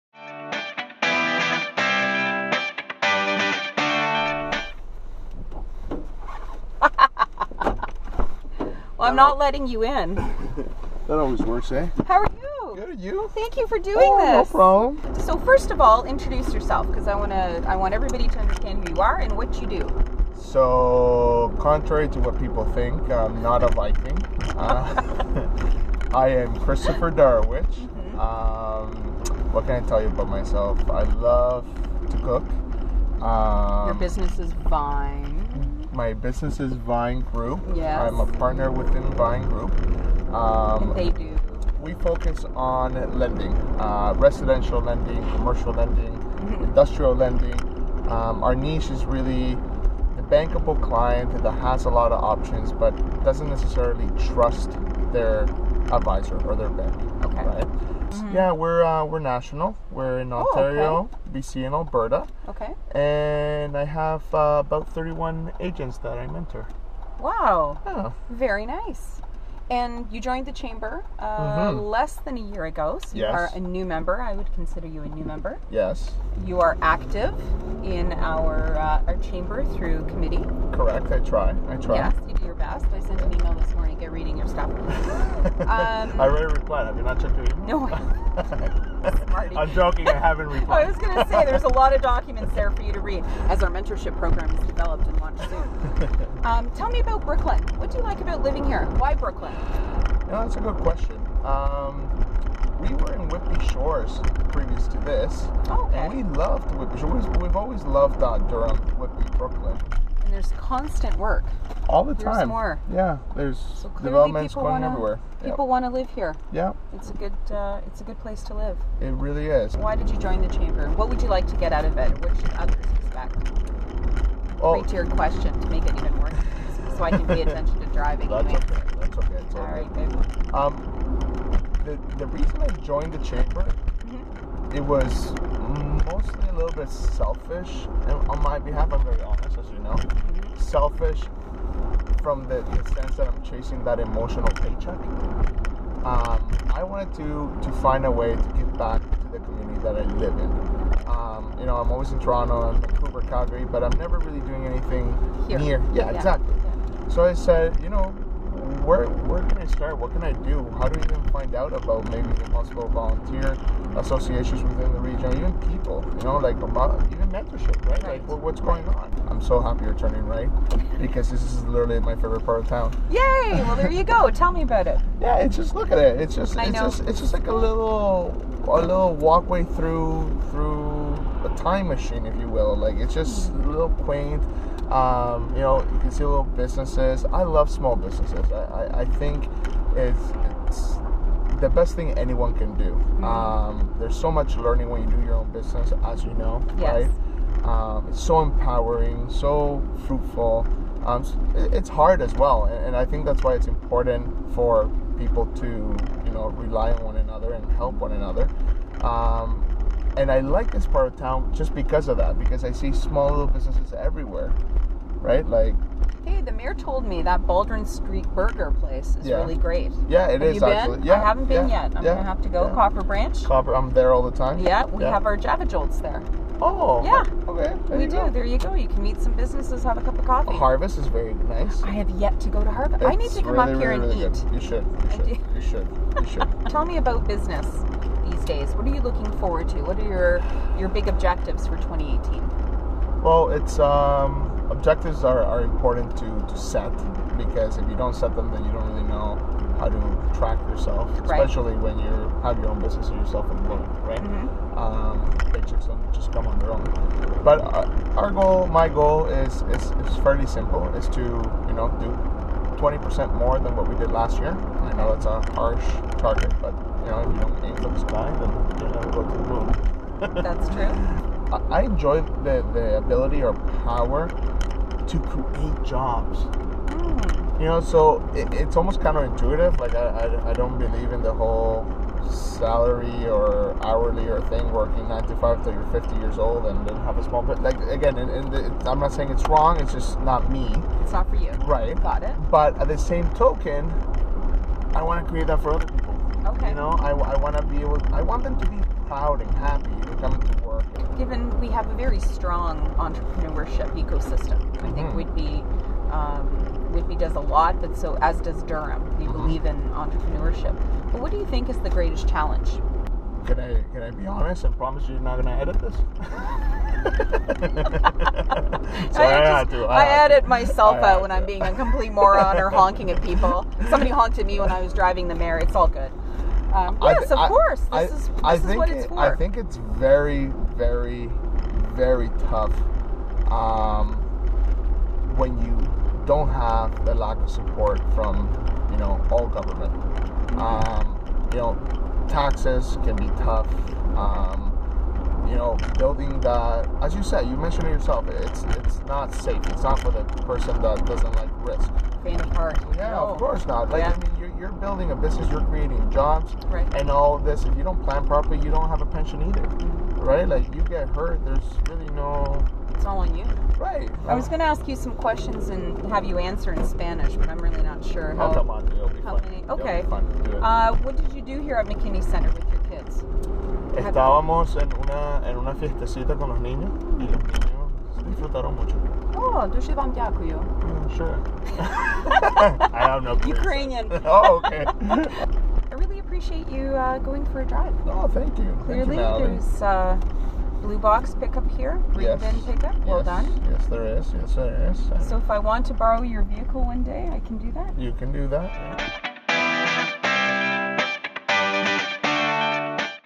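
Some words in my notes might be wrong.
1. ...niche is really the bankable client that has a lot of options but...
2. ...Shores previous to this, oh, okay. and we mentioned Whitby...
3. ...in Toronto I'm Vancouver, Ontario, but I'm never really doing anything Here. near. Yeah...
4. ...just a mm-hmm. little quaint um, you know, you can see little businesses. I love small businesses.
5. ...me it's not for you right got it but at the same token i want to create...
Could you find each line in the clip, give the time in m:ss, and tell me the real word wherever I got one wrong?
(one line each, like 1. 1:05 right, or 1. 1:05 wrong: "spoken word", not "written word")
1. 0:48 right
2. 1:43 wrong: "loved", not "mentioned"
3. 2:32 wrong: "Calgary", not "Ontario"
4. 3:03 right
5. 4:50 right.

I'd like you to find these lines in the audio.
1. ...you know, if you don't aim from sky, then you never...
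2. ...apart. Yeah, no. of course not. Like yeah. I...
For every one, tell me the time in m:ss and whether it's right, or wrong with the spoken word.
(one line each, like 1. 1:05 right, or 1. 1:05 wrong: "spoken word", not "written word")
1. 4:27 right
2. 5:52 right.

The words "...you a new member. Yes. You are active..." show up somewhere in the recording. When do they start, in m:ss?
1:14.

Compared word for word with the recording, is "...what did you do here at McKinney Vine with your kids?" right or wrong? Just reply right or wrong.
wrong.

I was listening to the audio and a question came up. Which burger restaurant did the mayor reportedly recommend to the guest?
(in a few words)
Baldwin Street Burger.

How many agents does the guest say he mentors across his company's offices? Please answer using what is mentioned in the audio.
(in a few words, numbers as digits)
31.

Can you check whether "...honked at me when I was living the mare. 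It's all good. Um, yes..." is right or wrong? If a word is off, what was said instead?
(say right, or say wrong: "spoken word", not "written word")
wrong: "driving", not "living".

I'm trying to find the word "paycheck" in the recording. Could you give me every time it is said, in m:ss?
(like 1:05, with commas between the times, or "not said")
2:24, 4:15.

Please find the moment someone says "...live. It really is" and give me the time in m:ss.
1:58.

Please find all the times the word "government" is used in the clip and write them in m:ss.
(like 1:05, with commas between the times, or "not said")
5:39.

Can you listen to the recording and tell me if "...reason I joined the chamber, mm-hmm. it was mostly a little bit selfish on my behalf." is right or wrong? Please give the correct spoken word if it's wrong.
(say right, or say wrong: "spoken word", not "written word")
right.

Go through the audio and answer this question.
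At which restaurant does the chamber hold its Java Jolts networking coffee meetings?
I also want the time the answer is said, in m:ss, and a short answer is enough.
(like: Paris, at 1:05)
Copper Branch, at 3:42.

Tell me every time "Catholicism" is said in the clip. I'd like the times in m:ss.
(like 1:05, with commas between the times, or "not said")
not said.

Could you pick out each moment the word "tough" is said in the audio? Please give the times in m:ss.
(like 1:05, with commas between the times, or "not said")
5:32, 5:43.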